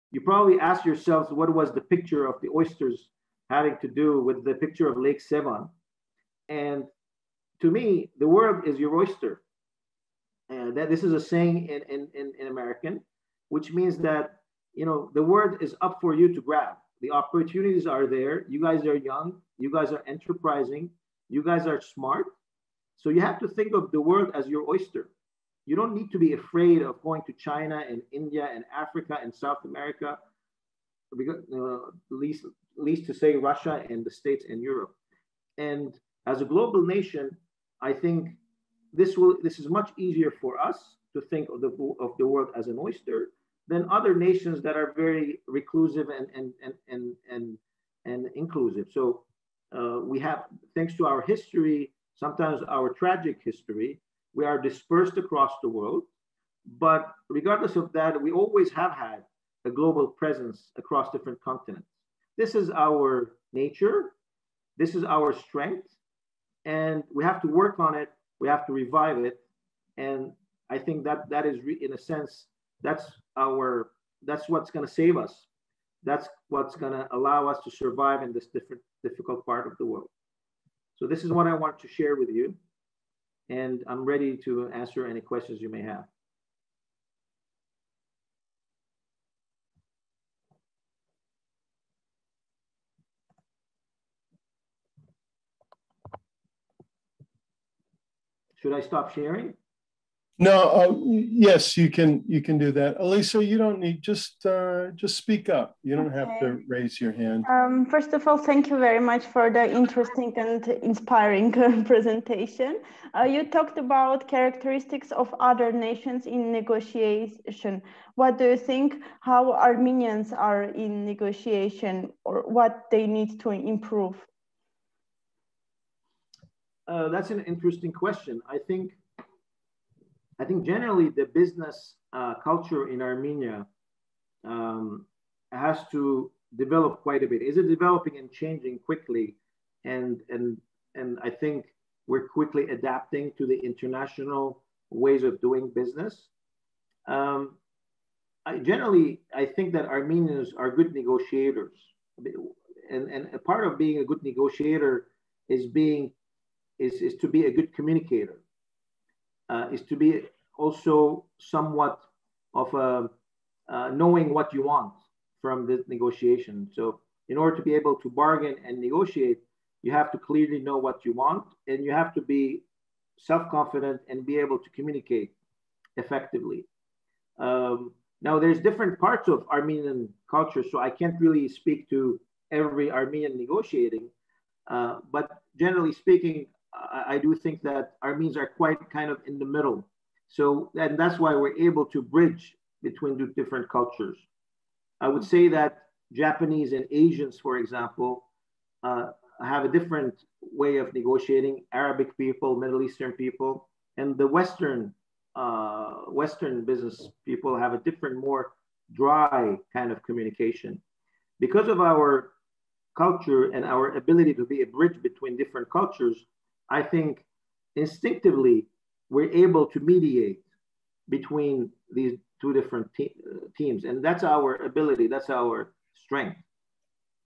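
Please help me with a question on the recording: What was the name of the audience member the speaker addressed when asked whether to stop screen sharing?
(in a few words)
Elisa.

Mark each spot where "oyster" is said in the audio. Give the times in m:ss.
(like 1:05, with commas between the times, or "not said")
0:02, 0:08, 0:24, 0:42.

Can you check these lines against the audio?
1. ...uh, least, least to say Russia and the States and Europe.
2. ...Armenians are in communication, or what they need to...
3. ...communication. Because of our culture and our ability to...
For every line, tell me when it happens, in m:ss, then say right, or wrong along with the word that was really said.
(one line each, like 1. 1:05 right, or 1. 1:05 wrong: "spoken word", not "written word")
1. 0:31 right
2. 1:59 wrong: "negotiation", not "communication"
3. 3:30 right.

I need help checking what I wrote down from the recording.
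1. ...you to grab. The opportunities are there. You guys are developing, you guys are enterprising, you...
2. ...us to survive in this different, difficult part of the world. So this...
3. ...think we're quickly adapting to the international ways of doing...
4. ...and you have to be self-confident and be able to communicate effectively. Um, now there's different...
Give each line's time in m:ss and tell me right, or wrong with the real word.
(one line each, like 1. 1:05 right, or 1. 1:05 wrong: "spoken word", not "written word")
1. 0:16 wrong: "young", not "developing"
2. 1:17 right
3. 2:21 right
4. 2:51 right.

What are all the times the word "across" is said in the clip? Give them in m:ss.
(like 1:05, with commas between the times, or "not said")
0:55, 1:00.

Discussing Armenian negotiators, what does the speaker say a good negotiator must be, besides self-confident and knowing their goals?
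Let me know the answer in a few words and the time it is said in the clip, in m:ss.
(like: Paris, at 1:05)
A good communicator, at 2:37.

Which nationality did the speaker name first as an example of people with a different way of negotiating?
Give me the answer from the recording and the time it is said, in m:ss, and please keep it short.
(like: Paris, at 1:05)
Japanese, at 3:16.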